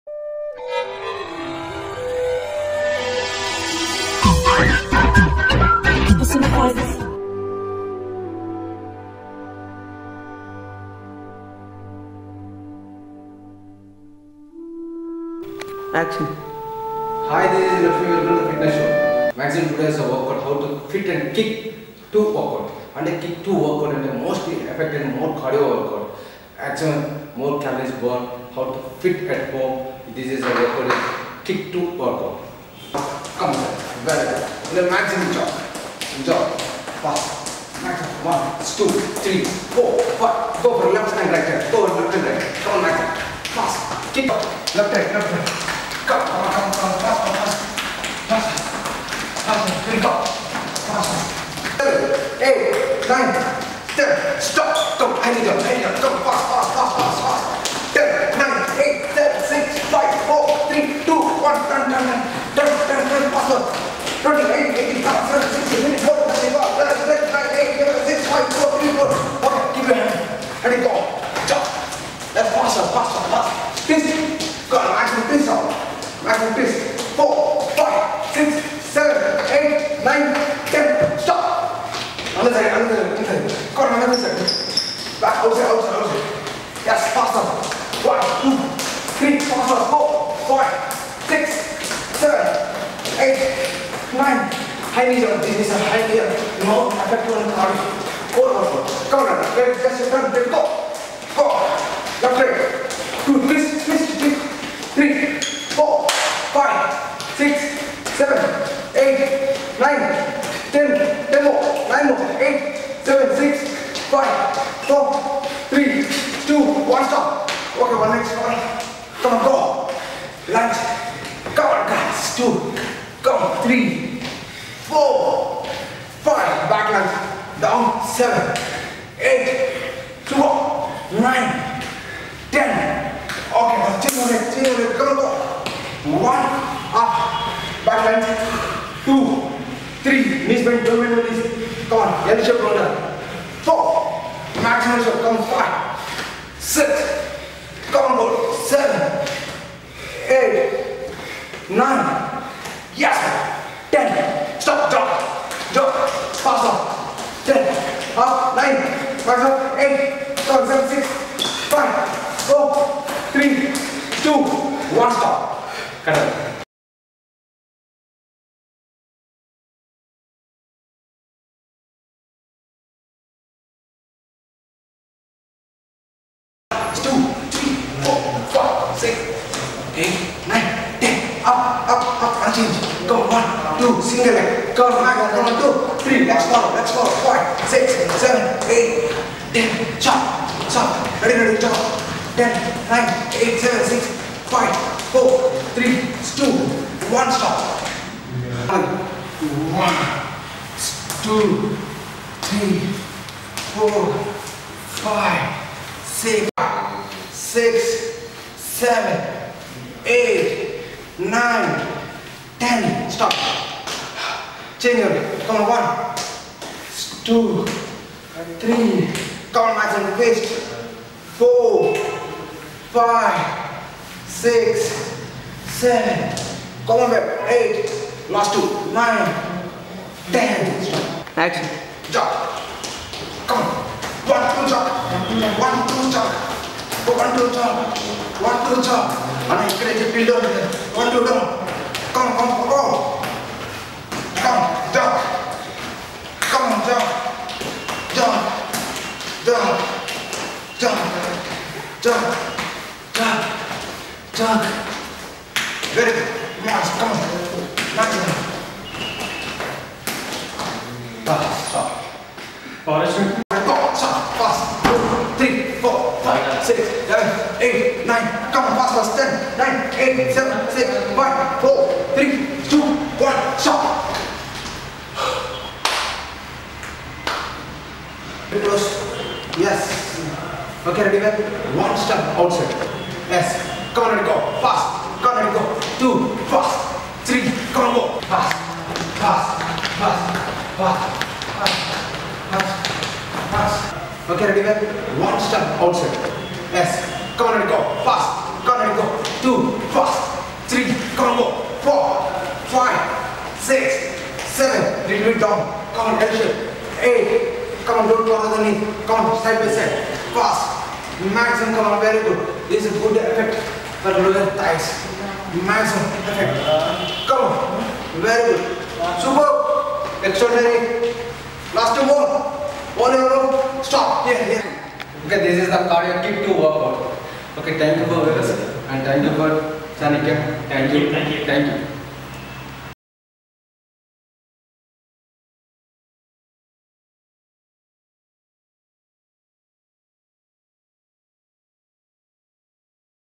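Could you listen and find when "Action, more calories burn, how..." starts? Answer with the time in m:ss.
0:26.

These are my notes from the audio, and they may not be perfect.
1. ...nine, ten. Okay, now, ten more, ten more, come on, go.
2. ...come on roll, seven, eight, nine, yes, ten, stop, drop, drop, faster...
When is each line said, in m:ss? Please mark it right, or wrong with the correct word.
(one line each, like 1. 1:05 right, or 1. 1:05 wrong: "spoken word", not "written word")
1. 2:11 right
2. 2:27 right.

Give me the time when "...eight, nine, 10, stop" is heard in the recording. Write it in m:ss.
3:30.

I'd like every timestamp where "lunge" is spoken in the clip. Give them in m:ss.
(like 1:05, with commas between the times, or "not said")
2:00, 2:06.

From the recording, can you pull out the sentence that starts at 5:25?
Okay, this is the cardio kick to work out.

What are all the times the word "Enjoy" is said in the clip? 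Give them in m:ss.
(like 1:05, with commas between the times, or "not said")
0:36.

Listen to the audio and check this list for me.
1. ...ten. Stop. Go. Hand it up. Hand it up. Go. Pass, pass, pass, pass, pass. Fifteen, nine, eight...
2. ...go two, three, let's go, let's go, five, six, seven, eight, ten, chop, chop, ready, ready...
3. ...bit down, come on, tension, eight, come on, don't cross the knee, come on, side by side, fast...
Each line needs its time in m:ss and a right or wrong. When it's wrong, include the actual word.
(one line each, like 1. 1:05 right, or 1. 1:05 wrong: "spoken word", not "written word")
1. 0:53 wrong: "Ten", not "Fifteen"
2. 3:05 right
3. 5:05 right.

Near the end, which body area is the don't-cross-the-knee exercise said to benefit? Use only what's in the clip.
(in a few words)
Lower thighs.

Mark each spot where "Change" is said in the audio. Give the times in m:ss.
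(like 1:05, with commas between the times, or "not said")
3:34.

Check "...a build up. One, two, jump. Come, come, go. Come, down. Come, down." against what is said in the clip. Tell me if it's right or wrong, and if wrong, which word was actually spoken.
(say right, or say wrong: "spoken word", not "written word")
right.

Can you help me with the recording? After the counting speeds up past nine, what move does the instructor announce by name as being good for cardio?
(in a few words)
High knee jump.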